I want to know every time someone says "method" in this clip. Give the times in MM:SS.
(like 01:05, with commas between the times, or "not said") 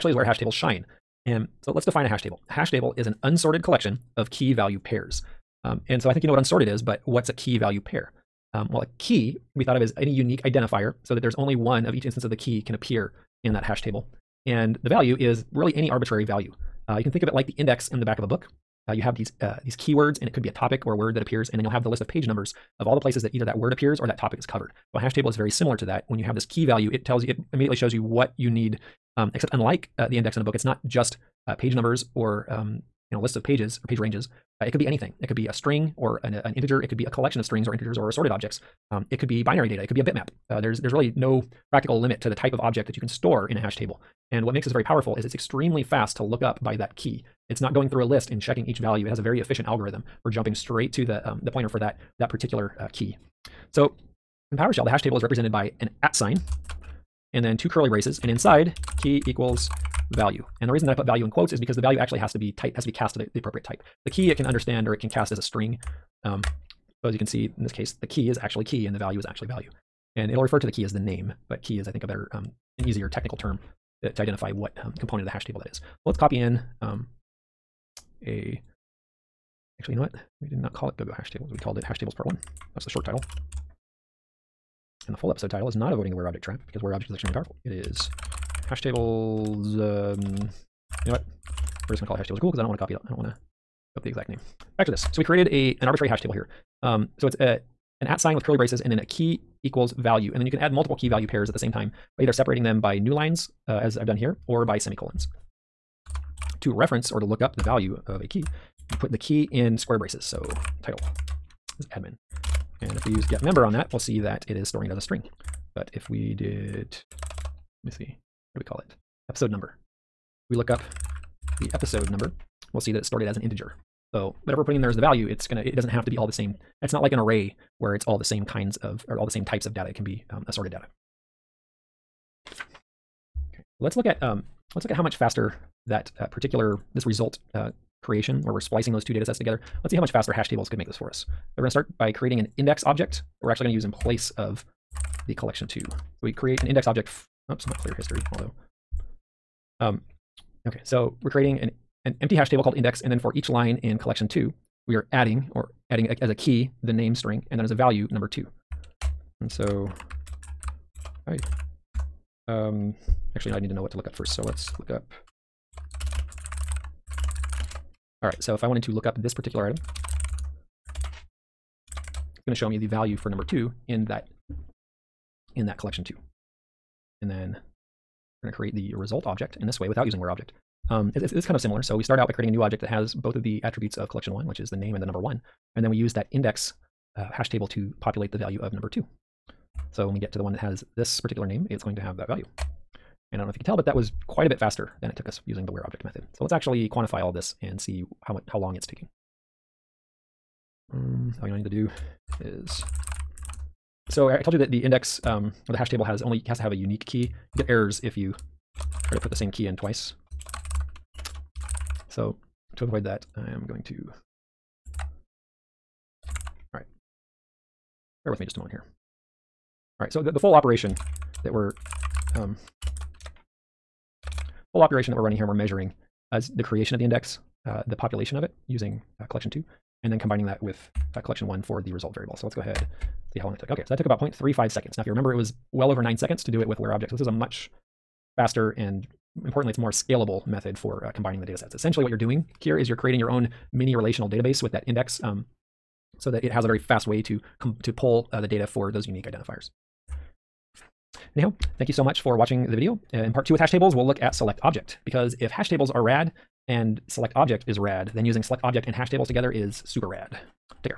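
03:16, 04:00.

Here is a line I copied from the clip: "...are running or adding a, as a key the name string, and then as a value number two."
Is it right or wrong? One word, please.
wrong.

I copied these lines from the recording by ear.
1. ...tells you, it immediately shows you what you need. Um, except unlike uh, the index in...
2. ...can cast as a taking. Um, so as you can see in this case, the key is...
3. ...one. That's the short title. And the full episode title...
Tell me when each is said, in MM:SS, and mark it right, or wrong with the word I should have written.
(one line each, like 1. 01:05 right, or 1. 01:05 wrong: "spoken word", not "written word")
1. 00:27 right
2. 01:04 wrong: "string", not "taking"
3. 01:22 right.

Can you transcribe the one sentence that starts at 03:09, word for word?
So when we get to the one that has this particular name, it's going to have that value.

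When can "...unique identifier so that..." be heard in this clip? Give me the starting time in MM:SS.
00:10.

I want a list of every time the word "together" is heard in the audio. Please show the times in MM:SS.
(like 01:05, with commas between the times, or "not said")
02:19, 04:19.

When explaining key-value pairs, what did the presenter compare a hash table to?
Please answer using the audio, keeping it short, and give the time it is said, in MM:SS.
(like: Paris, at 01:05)
index in the back of a book, at 00:17.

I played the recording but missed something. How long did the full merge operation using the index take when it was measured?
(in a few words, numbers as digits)
0.35 seconds.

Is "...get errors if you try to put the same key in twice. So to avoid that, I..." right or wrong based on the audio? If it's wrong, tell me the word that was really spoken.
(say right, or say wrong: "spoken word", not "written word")
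right.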